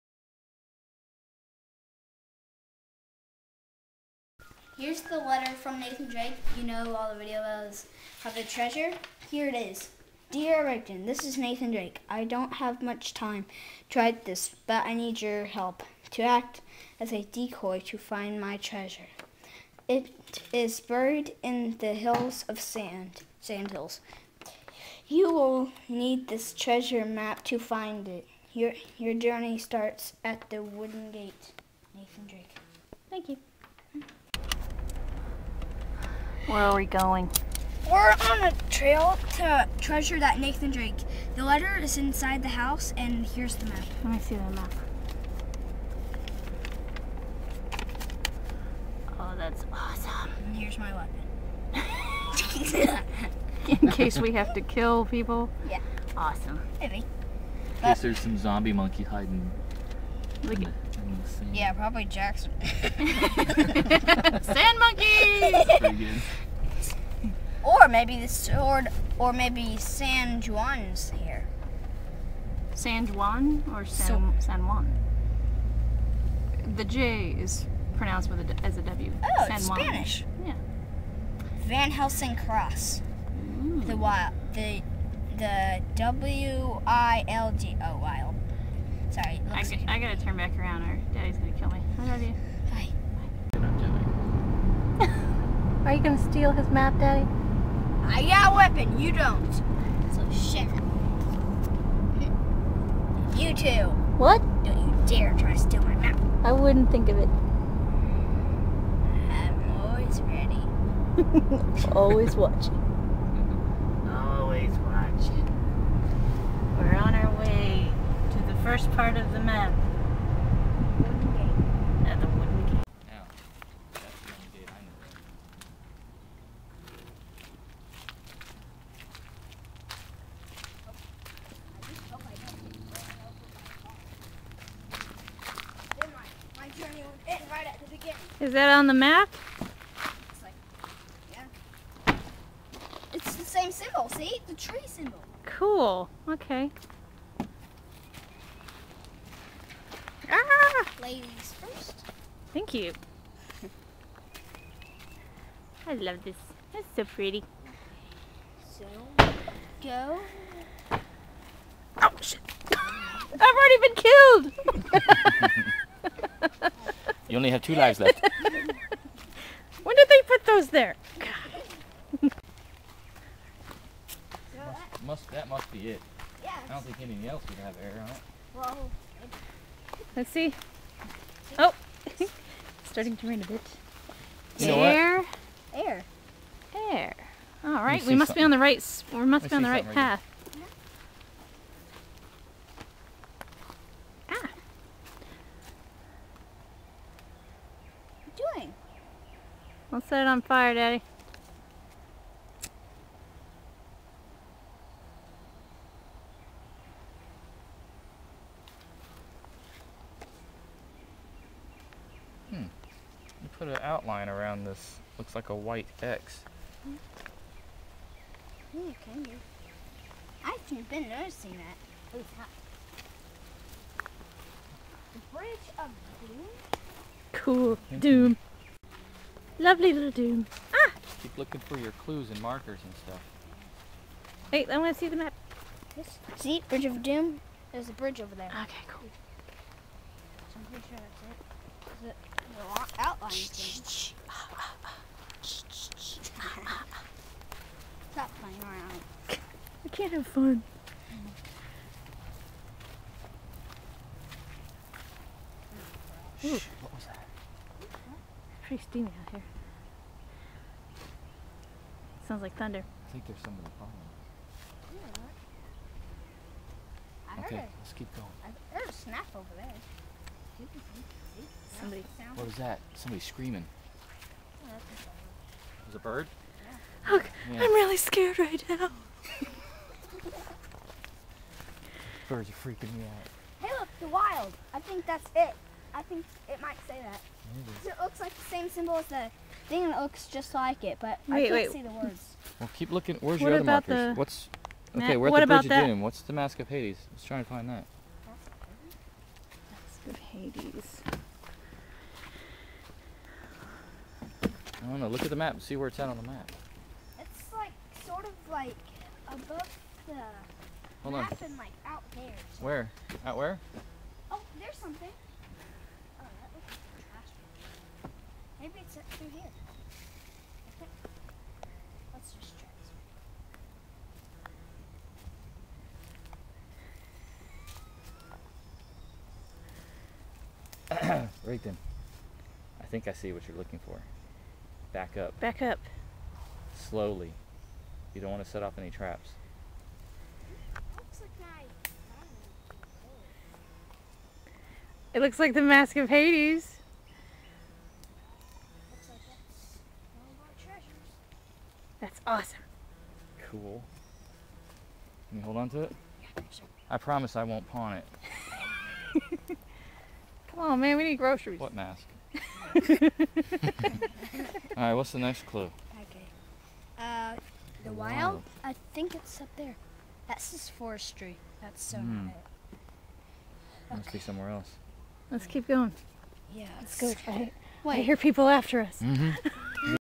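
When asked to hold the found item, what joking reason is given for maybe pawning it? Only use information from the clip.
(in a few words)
Groceries.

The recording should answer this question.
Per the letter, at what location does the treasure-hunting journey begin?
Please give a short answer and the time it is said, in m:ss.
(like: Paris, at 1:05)
The wooden gate, at 0:30.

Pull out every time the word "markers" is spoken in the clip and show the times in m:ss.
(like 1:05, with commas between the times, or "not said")
3:52, 4:53.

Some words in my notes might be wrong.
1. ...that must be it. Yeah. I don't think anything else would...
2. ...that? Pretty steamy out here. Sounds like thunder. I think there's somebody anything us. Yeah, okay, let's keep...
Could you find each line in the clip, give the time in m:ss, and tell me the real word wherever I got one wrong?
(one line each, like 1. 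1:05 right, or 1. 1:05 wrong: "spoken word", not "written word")
1. 2:55 right
2. 4:17 wrong: "following", not "anything".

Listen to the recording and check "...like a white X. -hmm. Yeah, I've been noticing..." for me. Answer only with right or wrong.
right.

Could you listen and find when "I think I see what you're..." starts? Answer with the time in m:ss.
5:32.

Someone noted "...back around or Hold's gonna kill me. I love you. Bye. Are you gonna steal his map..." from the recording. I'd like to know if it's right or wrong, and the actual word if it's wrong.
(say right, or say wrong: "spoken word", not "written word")
wrong: "Daddy", not "Hold".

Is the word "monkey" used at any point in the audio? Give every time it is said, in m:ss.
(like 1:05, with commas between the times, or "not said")
0:58, 1:04.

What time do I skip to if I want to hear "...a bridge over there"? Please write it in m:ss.
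3:57.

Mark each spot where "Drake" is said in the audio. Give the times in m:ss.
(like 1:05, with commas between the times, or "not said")
0:06, 0:11, 0:32, 0:40.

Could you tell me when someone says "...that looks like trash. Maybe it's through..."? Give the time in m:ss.
5:16.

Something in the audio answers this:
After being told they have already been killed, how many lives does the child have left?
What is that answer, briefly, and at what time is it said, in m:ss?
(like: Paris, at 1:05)
2, at 2:47.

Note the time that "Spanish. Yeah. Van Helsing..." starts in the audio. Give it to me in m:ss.
1:19.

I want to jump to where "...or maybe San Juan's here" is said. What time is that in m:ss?
1:09.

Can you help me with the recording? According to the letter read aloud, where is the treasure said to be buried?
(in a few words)
Sand hills.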